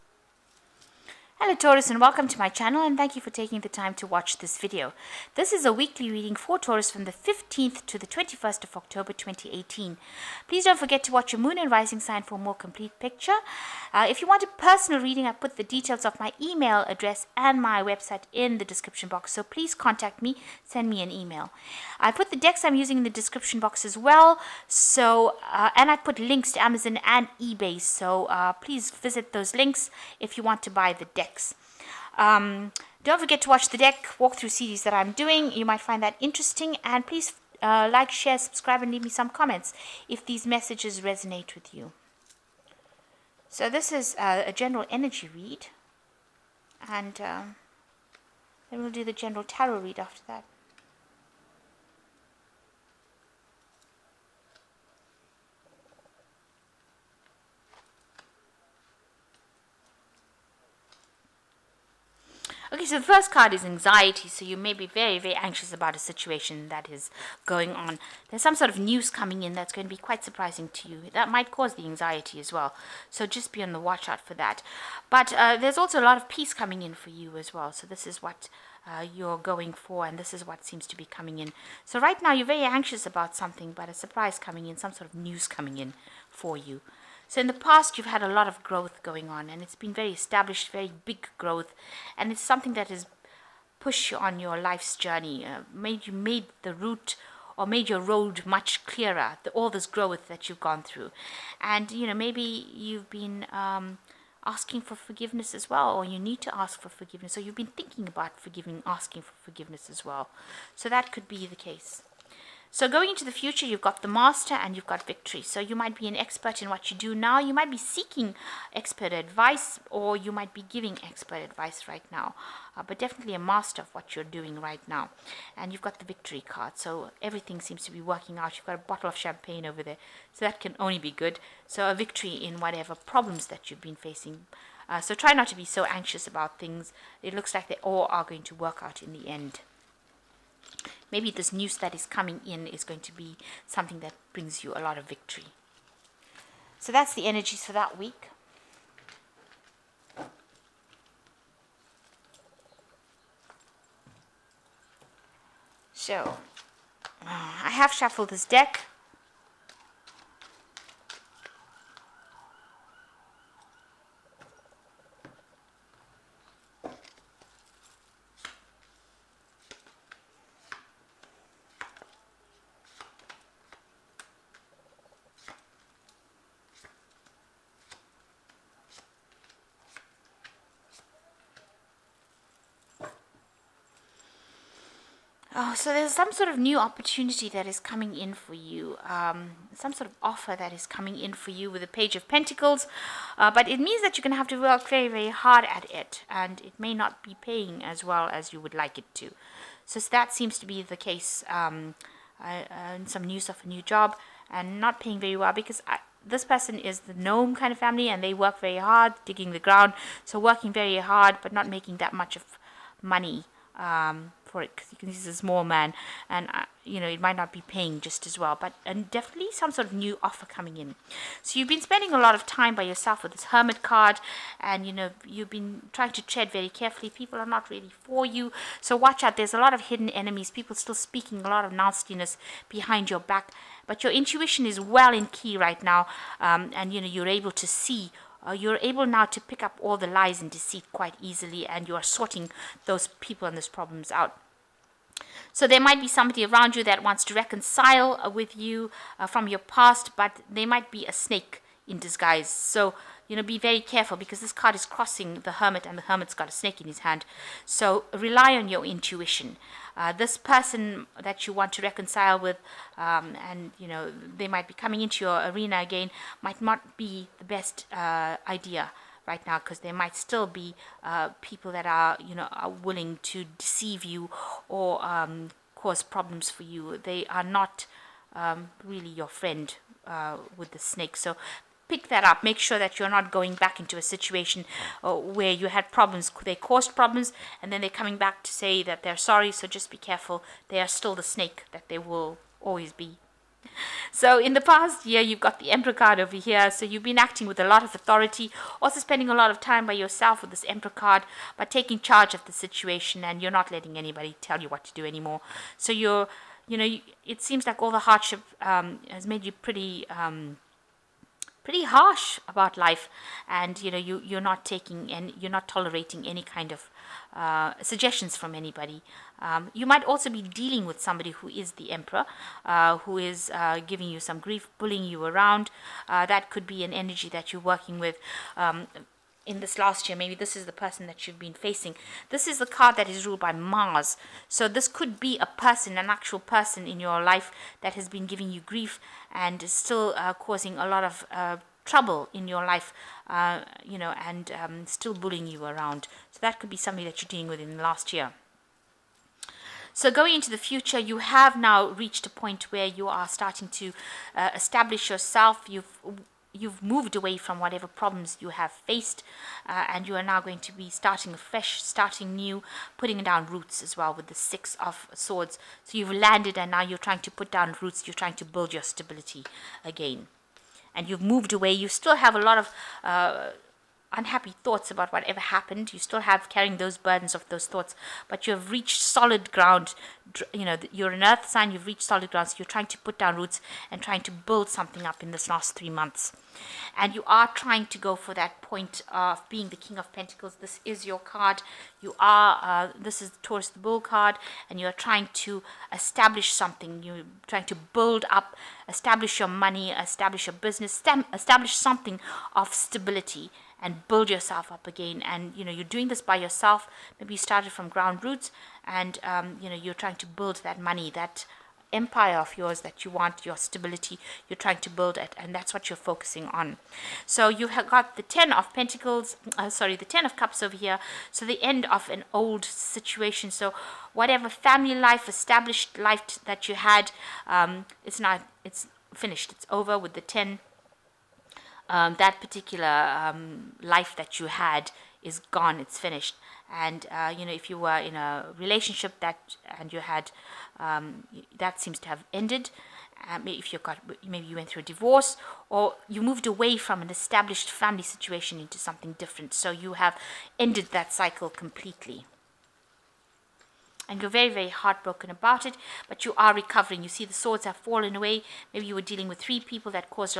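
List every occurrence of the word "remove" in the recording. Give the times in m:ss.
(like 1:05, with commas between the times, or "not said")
not said.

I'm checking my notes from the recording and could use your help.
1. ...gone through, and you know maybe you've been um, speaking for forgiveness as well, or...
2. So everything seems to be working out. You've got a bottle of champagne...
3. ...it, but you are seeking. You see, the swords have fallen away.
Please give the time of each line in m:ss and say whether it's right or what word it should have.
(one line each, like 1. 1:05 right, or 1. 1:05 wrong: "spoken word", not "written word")
1. 1:40 wrong: "asking", not "speaking"
2. 2:06 right
3. 7:35 wrong: "recovering", not "seeking".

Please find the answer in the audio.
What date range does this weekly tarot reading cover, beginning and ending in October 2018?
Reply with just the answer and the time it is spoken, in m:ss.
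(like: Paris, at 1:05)
15th to 21st of October 2018, at 0:07.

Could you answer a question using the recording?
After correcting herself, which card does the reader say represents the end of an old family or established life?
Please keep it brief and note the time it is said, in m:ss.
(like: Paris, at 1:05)
Ten of Cups, at 7:00.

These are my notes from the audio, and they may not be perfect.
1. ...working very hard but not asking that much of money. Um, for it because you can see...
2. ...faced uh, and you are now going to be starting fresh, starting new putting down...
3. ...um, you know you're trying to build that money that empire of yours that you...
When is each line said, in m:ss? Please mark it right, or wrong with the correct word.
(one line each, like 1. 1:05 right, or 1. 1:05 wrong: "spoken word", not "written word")
1. 3:30 wrong: "making", not "asking"
2. 5:58 right
3. 6:49 right.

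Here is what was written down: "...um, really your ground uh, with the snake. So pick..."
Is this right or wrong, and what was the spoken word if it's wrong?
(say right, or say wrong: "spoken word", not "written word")
wrong: "friend", not "ground".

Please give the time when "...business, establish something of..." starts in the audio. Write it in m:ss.
6:40.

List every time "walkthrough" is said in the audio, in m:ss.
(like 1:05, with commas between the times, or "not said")
0:34.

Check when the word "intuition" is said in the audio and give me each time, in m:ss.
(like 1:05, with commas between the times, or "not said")
3:54, 4:18.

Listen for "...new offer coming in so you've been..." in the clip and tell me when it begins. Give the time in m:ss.
3:39.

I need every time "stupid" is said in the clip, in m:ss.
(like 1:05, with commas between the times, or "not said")
not said.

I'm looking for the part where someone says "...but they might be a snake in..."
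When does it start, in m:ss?
4:10.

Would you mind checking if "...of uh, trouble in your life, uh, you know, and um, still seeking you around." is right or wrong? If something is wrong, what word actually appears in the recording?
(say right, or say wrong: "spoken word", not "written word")
wrong: "bullying", not "seeking".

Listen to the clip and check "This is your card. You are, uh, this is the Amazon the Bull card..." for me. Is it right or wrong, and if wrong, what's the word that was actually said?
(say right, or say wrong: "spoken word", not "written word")
wrong: "Taurus", not "Amazon".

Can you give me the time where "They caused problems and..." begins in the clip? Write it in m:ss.
4:46.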